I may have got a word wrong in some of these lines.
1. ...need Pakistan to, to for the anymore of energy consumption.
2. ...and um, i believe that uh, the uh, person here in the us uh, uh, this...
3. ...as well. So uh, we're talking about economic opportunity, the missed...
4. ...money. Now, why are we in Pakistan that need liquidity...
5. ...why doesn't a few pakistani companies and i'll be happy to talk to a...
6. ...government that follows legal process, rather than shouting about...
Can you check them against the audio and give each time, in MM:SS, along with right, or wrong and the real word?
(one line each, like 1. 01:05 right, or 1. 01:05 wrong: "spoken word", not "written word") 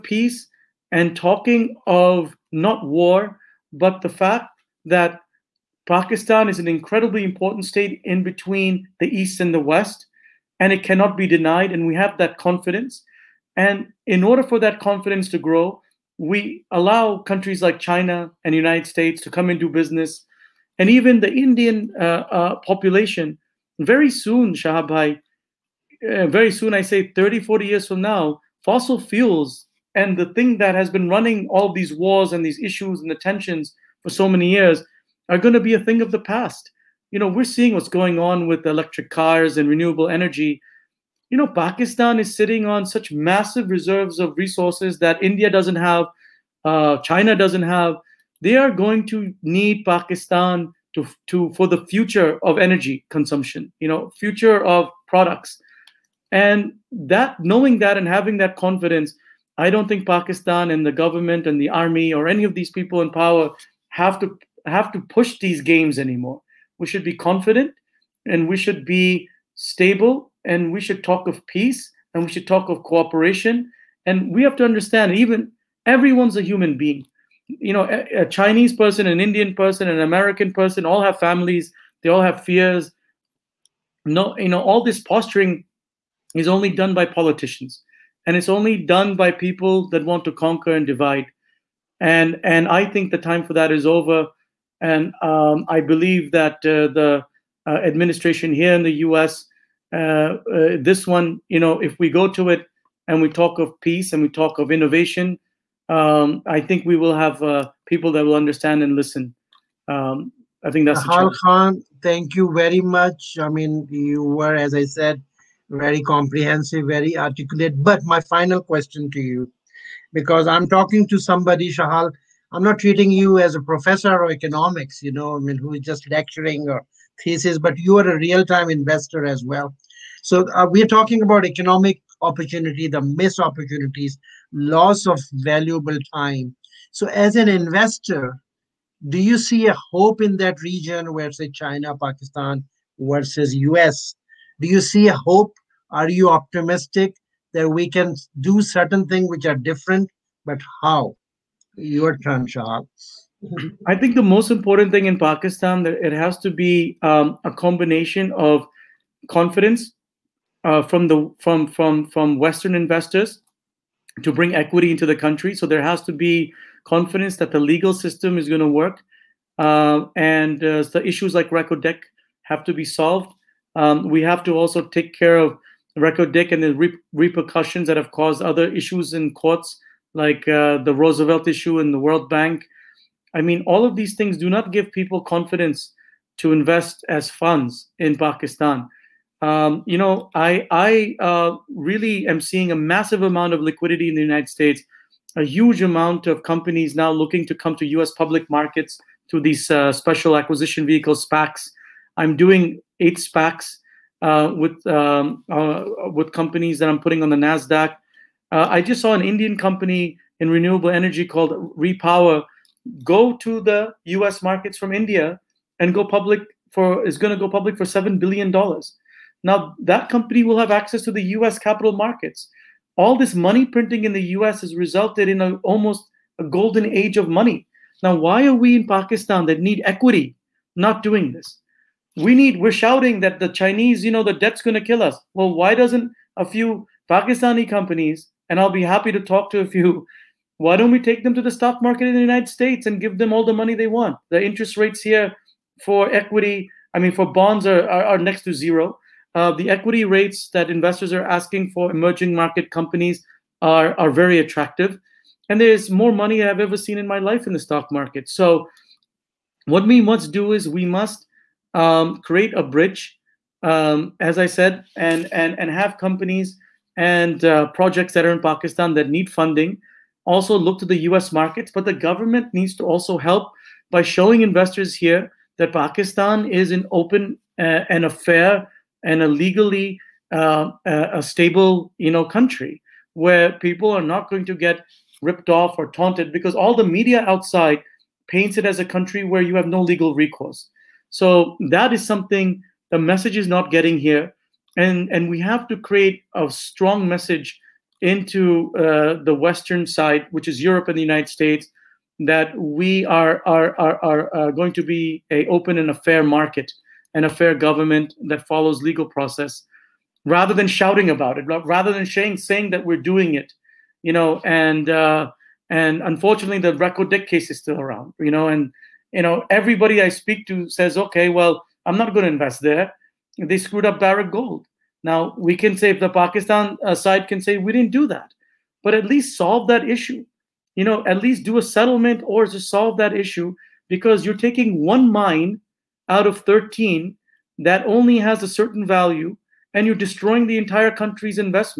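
1. 00:49 wrong: "future", not "anymore"
2. 01:34 wrong: "administration", not "person"
3. 02:09 right
4. 03:47 wrong: "equity", not "liquidity"
5. 03:55 right
6. 05:07 right.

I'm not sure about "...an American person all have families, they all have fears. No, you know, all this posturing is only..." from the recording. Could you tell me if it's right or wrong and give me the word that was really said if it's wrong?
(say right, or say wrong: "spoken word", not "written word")
right.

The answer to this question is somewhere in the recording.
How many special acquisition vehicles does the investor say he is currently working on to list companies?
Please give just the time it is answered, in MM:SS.
03:22.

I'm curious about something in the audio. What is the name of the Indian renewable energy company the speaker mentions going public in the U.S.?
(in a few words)
Repower.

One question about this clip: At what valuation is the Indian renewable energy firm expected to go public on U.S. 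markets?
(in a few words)
$7 billion.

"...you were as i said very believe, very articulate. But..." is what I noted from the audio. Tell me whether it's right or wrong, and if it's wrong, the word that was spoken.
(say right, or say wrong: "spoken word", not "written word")
wrong: "comprehensive", not "believe".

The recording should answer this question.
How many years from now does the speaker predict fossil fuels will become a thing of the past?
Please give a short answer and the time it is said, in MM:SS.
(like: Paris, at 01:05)
30 to 40 years, at 00:27.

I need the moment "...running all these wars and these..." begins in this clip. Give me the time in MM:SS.
00:31.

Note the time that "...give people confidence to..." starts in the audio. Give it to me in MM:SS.
03:04.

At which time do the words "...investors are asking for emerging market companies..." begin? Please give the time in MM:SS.
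04:10.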